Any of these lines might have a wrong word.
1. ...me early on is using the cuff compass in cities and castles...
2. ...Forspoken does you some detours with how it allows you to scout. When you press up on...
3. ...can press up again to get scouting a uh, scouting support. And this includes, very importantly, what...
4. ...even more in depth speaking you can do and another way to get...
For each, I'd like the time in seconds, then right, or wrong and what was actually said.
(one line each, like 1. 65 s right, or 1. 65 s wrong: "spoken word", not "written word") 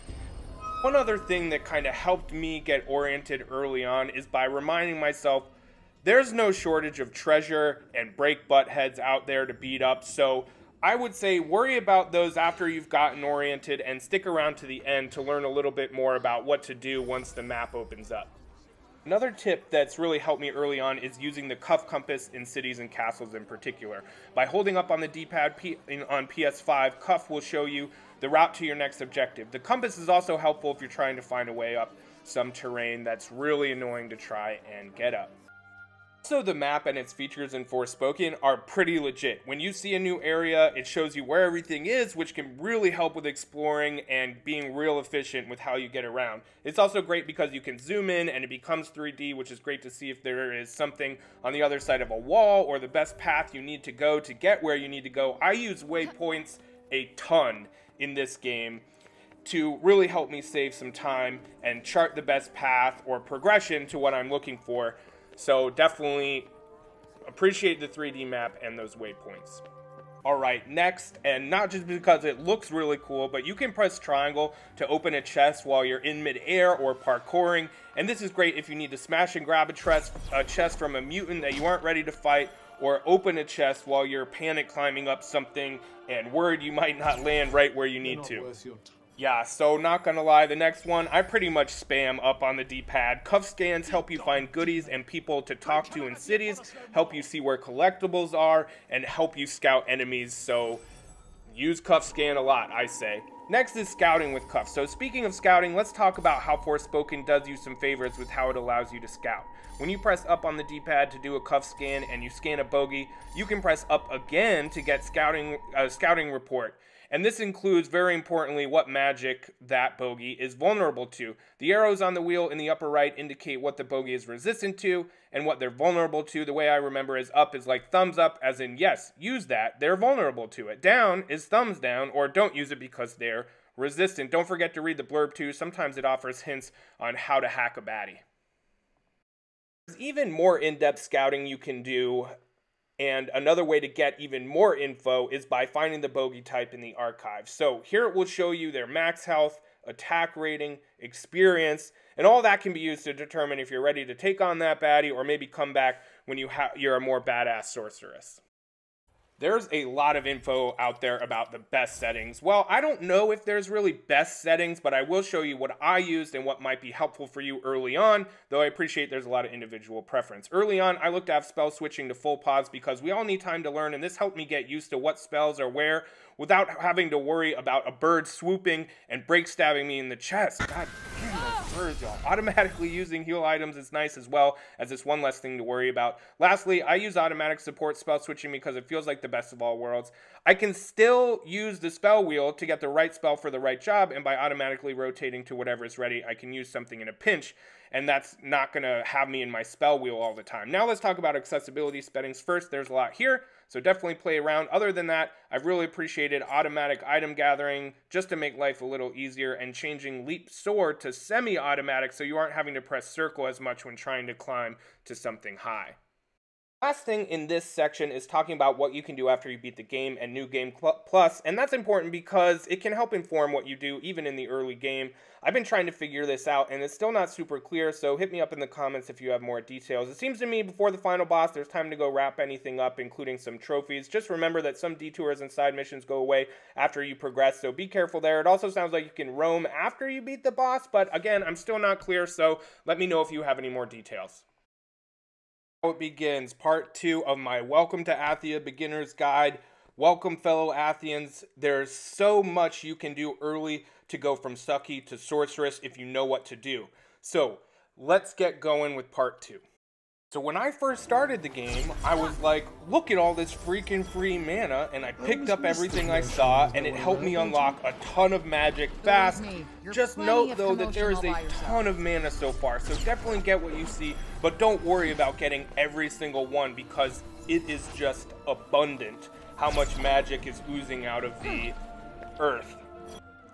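1. 20 s right
2. 106 s wrong: "favors", not "detours"
3. 113 s wrong: "report", not "support"
4. 139 s wrong: "scouting", not "speaking".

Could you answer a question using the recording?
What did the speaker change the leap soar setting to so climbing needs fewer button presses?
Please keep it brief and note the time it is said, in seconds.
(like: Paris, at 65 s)
Semi-automatic, at 211 s.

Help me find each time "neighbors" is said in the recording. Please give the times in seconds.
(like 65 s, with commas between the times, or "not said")
not said.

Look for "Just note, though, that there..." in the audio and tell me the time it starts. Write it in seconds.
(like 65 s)
269 s.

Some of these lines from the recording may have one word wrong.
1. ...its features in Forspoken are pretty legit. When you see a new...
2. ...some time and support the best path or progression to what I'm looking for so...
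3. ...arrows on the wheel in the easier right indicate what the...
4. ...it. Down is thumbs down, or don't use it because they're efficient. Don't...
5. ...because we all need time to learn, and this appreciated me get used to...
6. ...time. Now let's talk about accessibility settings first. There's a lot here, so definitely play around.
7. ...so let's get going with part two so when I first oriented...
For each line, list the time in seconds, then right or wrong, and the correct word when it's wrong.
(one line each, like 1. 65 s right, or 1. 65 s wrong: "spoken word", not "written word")
1. 36 s right
2. 60 s wrong: "chart", not "support"
3. 121 s wrong: "upper", not "easier"
4. 130 s wrong: "resistant", not "efficient"
5. 172 s wrong: "helped", not "appreciated"
6. 200 s right
7. 257 s wrong: "started", not "oriented".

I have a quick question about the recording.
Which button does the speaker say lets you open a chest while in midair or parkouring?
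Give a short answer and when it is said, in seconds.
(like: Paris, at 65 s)
Triangle, at 73 s.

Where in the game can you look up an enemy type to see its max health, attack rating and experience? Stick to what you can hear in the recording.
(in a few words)
The archive.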